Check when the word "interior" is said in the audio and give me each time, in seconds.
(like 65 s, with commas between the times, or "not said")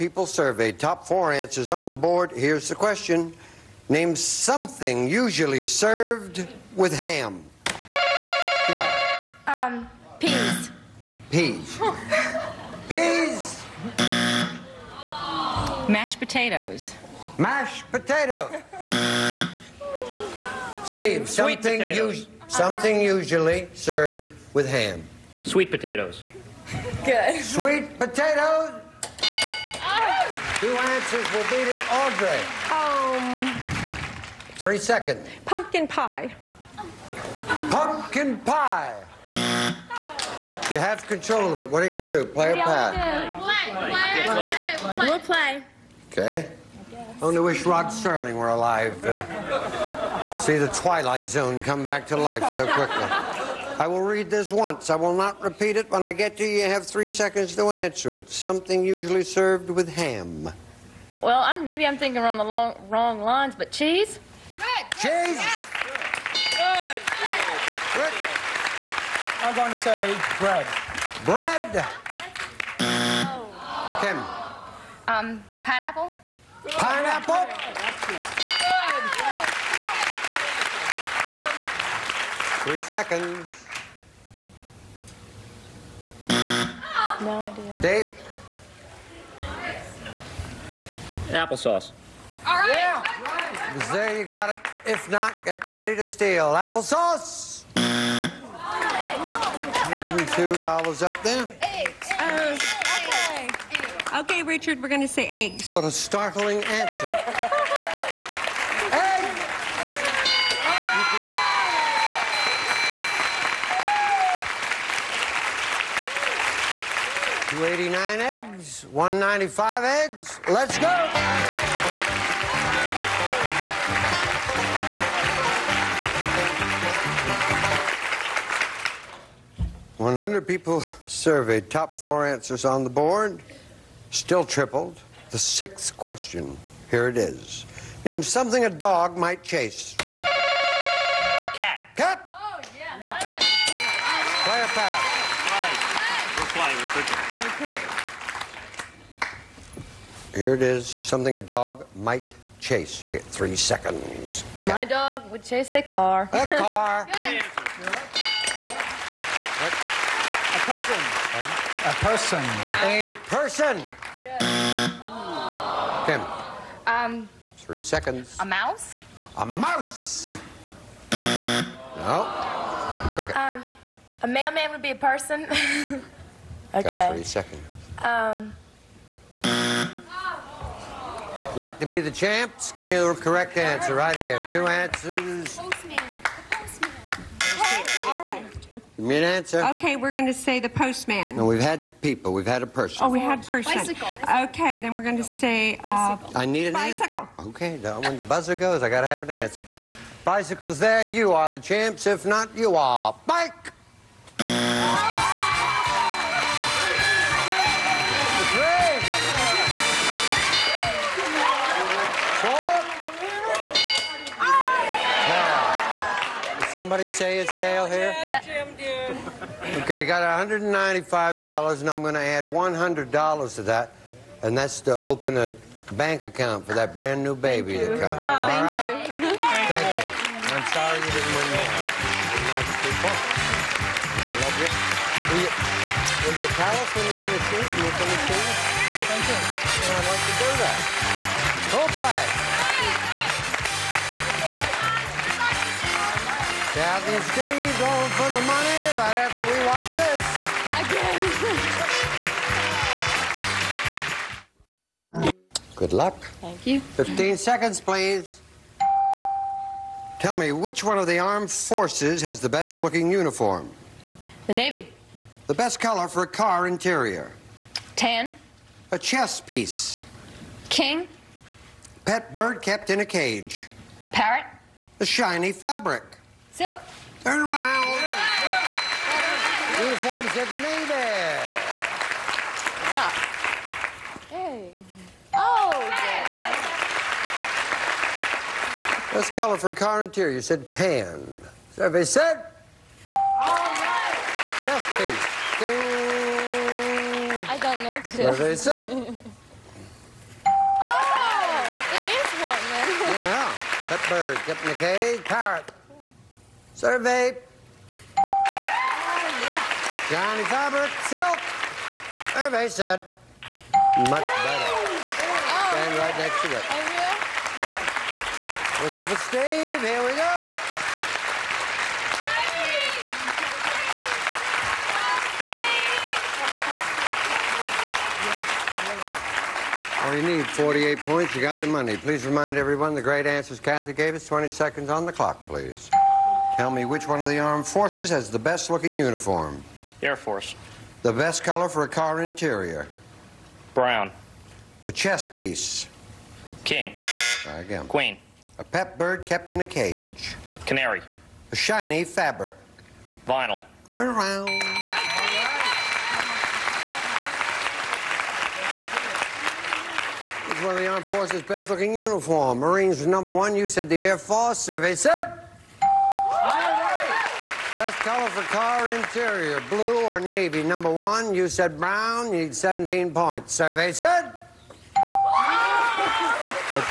266 s, 290 s, 342 s, 368 s.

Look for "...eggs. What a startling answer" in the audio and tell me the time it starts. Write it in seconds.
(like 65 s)
105 s.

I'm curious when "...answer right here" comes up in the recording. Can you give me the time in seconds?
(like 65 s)
183 s.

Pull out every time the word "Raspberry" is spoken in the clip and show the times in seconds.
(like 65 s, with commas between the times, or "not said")
not said.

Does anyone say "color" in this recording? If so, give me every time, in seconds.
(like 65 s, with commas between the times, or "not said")
265 s, 289 s, 341 s, 367 s.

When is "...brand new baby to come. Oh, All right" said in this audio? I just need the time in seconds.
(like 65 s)
226 s.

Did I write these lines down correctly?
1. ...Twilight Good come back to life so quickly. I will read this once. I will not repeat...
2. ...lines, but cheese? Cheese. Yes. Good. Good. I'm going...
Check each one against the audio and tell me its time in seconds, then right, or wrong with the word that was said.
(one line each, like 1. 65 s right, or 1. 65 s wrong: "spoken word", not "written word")
1. 50 s wrong: "Zone", not "Good"
2. 63 s right.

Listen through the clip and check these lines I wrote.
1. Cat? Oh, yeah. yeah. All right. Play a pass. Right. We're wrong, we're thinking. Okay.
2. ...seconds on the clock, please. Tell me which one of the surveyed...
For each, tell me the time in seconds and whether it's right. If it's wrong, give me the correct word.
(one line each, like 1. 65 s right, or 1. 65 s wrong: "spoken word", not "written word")
1. 141 s wrong: "flying", not "wrong"
2. 334 s wrong: "armed", not "surveyed".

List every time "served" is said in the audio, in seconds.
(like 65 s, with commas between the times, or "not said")
5 s, 23 s, 59 s.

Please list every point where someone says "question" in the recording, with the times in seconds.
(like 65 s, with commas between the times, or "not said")
2 s, 135 s.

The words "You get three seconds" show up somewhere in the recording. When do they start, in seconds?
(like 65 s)
153 s.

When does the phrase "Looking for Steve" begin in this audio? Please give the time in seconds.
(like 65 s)
318 s.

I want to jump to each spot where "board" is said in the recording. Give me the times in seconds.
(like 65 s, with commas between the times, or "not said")
1 s, 132 s.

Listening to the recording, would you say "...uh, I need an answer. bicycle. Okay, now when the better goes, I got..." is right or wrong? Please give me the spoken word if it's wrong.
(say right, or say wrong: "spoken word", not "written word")
wrong: "buzzer", not "better".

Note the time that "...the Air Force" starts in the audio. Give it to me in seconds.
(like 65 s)
363 s.